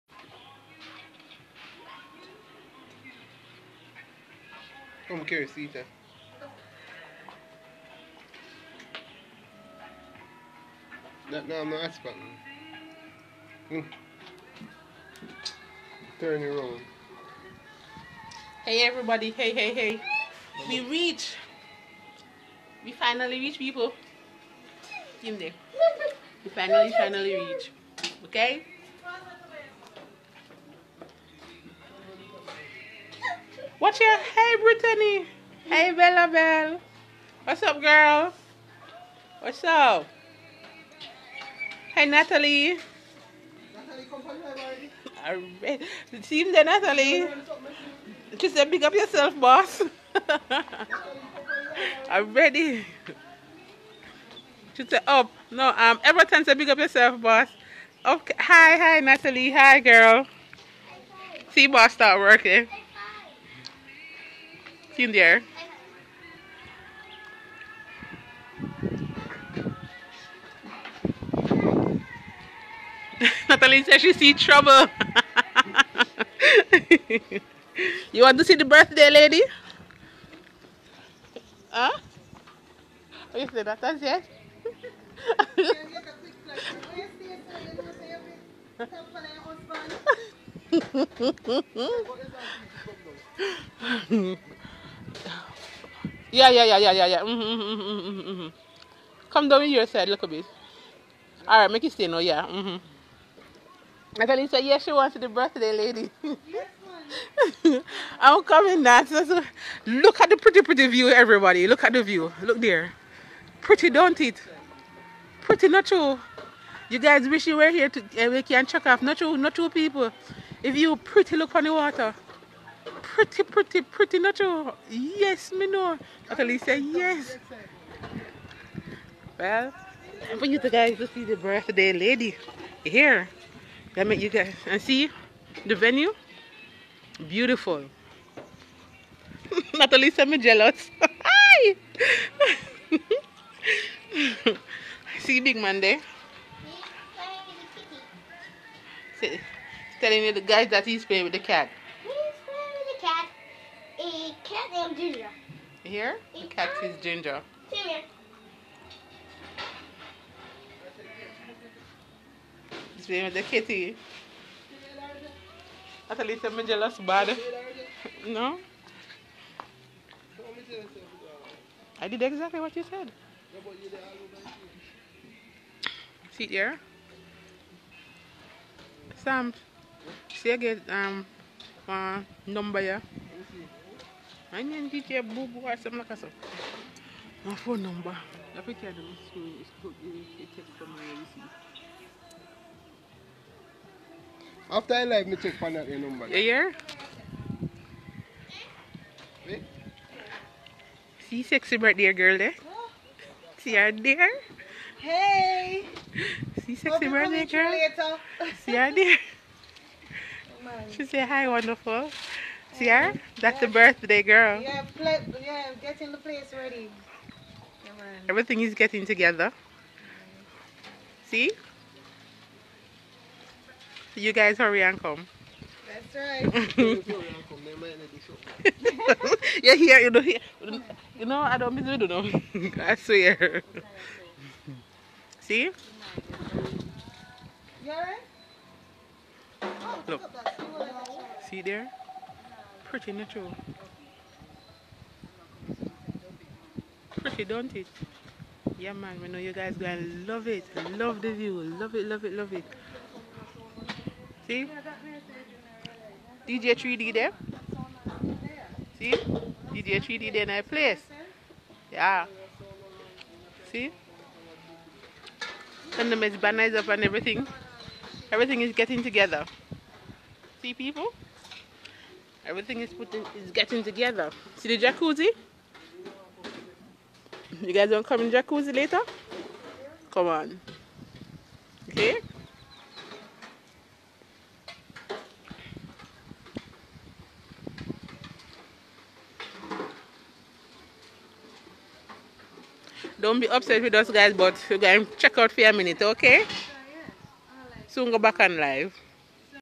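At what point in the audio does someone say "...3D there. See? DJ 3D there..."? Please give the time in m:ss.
4:16.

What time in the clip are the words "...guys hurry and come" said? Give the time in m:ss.
3:44.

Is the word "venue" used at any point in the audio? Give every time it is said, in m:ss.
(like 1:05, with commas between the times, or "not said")
2:15.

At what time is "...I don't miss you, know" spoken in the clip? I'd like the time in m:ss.
3:51.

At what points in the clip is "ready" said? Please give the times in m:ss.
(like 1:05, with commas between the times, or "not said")
0:52, 3:36.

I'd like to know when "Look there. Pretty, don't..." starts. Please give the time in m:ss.
1:52.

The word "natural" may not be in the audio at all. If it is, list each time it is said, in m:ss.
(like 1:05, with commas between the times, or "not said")
2:04, 4:03.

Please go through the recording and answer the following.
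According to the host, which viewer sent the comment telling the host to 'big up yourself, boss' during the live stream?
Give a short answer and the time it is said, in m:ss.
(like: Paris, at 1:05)
Everton, at 0:56.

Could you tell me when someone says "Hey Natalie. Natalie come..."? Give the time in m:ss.
0:41.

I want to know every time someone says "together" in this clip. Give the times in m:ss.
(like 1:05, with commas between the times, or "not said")
3:39, 4:29, 4:33.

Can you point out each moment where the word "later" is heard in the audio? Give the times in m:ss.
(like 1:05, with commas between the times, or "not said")
4:38.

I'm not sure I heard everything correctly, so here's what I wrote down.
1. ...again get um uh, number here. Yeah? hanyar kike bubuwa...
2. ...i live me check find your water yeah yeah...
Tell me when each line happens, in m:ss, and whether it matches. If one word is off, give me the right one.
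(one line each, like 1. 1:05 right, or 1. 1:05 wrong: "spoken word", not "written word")
1. 3:00 right
2. 3:14 wrong: "number", not "water".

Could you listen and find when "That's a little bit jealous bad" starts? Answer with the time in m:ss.
2:46.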